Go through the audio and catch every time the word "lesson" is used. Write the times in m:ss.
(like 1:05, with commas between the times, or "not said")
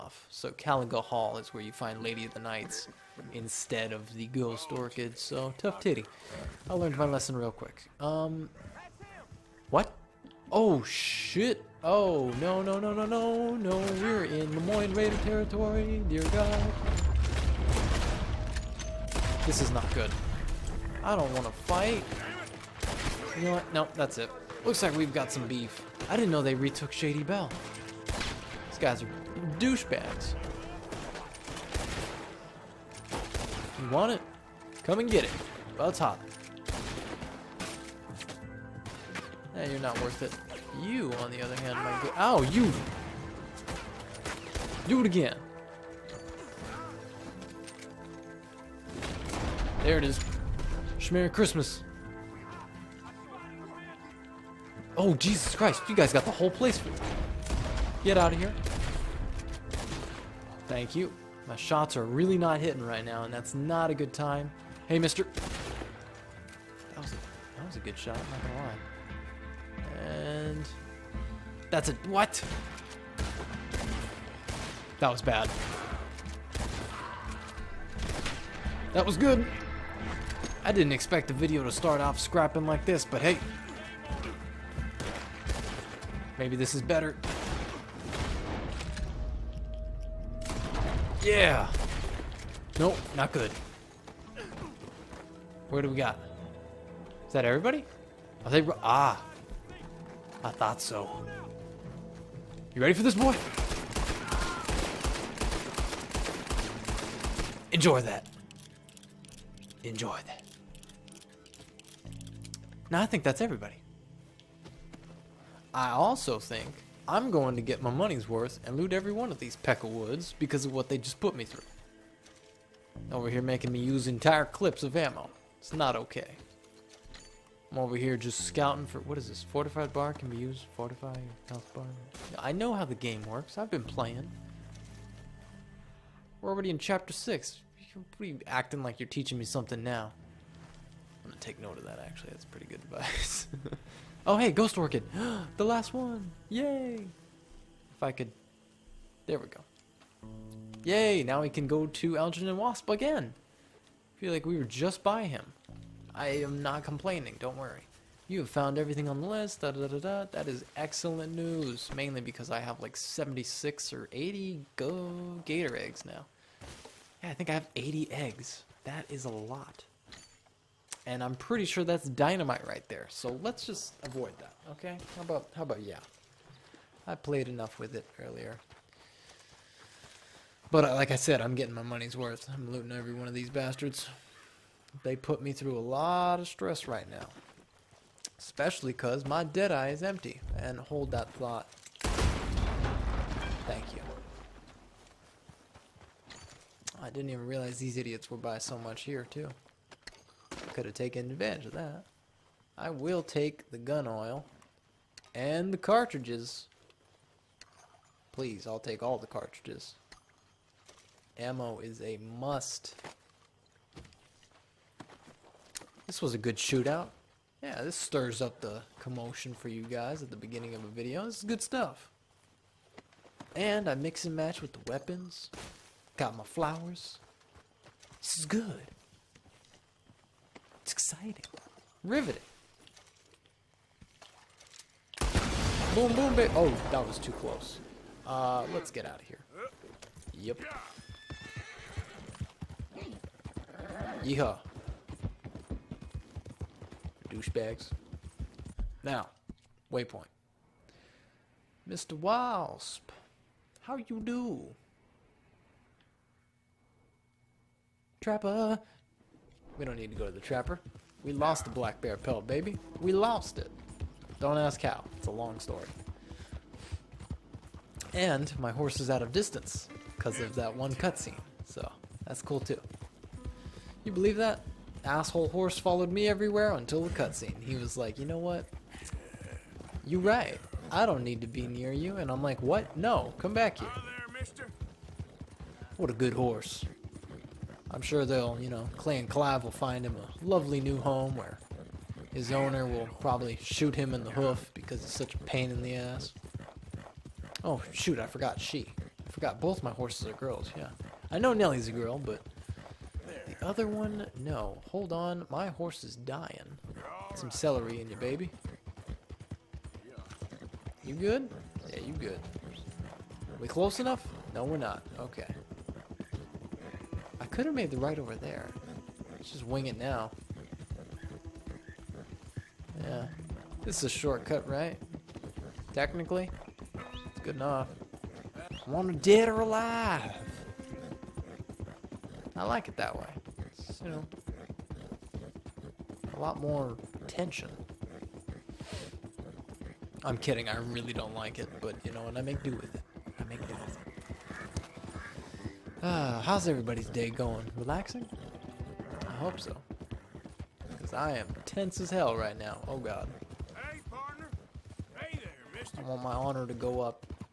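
0:07.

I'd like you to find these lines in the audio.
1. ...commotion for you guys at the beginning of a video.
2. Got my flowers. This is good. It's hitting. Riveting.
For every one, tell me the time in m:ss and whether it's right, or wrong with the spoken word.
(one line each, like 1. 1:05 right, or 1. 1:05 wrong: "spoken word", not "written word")
1. 3:38 right
2. 3:46 wrong: "exciting", not "hitting".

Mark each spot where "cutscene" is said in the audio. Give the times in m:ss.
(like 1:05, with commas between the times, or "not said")
4:30, 4:37.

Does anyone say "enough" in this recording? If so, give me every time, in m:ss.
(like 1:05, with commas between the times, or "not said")
2:57, 5:14, 5:27.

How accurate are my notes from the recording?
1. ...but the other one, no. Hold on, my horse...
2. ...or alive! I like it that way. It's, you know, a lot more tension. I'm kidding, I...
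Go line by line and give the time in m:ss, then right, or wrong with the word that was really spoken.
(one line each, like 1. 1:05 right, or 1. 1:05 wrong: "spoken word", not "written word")
1. 5:02 right
2. 5:29 right.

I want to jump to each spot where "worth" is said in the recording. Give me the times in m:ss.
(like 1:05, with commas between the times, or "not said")
0:40, 1:58, 3:02.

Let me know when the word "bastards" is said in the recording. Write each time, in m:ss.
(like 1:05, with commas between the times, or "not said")
3:03.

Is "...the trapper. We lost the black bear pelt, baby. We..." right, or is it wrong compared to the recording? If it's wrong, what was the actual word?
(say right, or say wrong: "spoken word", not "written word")
right.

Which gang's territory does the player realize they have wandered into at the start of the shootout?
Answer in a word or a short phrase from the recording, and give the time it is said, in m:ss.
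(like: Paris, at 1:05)
Lemoyne Raider, at 0:14.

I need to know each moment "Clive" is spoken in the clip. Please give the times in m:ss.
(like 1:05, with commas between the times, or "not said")
4:49.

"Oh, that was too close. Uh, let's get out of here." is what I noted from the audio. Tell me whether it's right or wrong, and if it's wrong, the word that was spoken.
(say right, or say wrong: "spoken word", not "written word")
right.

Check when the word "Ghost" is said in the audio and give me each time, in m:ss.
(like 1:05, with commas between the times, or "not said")
0:04, 2:24.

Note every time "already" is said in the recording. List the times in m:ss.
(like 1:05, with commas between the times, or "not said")
2:16.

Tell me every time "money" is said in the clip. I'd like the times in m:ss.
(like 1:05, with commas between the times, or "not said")
1:57, 3:01.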